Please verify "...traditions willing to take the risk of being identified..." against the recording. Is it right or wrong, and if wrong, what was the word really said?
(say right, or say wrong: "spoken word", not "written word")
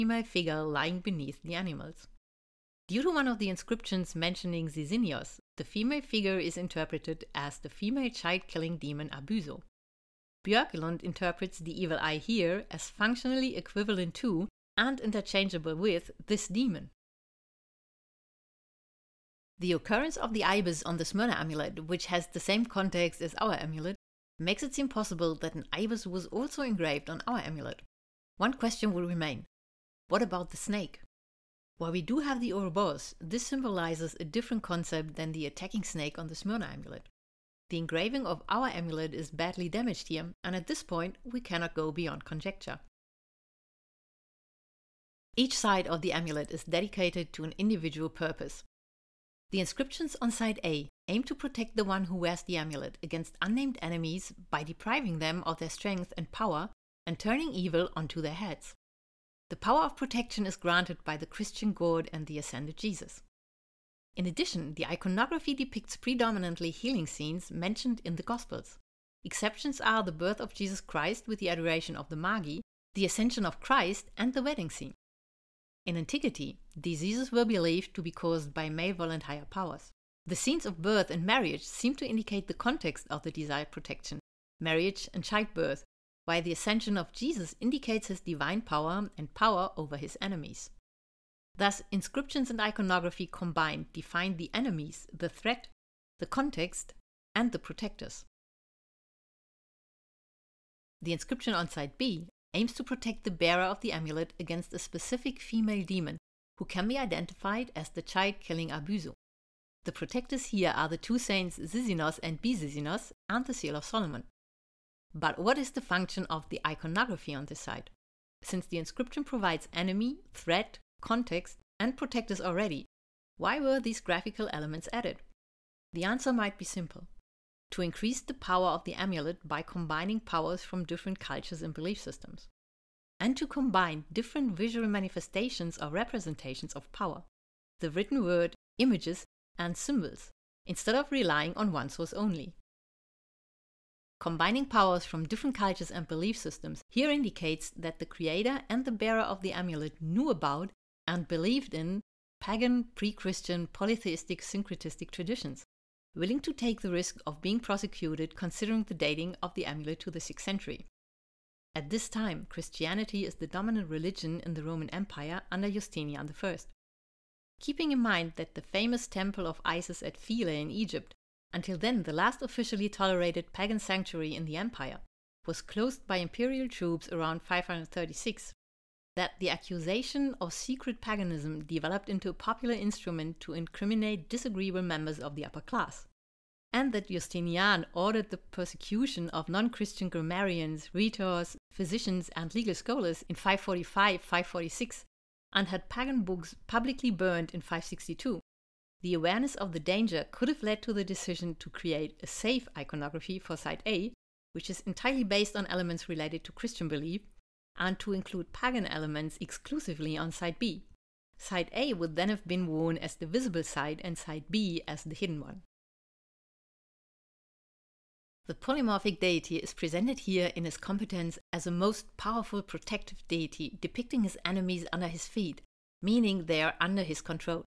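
wrong: "prosecuted", not "identified".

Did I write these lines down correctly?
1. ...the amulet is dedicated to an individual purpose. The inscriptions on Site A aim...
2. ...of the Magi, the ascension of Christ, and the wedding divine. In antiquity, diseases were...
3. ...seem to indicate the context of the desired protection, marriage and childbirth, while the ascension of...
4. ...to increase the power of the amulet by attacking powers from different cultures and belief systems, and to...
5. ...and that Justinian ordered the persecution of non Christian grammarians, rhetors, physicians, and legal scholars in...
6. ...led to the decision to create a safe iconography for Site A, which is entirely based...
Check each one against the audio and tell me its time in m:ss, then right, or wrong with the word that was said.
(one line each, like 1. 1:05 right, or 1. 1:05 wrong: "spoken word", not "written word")
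1. 0:45 right
2. 1:11 wrong: "scene", not "divine"
3. 1:21 right
4. 2:07 wrong: "combining", not "attacking"
5. 3:06 right
6. 3:20 right.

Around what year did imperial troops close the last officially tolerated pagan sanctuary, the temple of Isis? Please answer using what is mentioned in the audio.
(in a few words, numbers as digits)
536.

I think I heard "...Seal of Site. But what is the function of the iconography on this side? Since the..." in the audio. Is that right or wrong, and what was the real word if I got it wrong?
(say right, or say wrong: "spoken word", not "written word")
wrong: "Solomon", not "Site".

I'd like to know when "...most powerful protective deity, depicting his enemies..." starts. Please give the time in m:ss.
3:41.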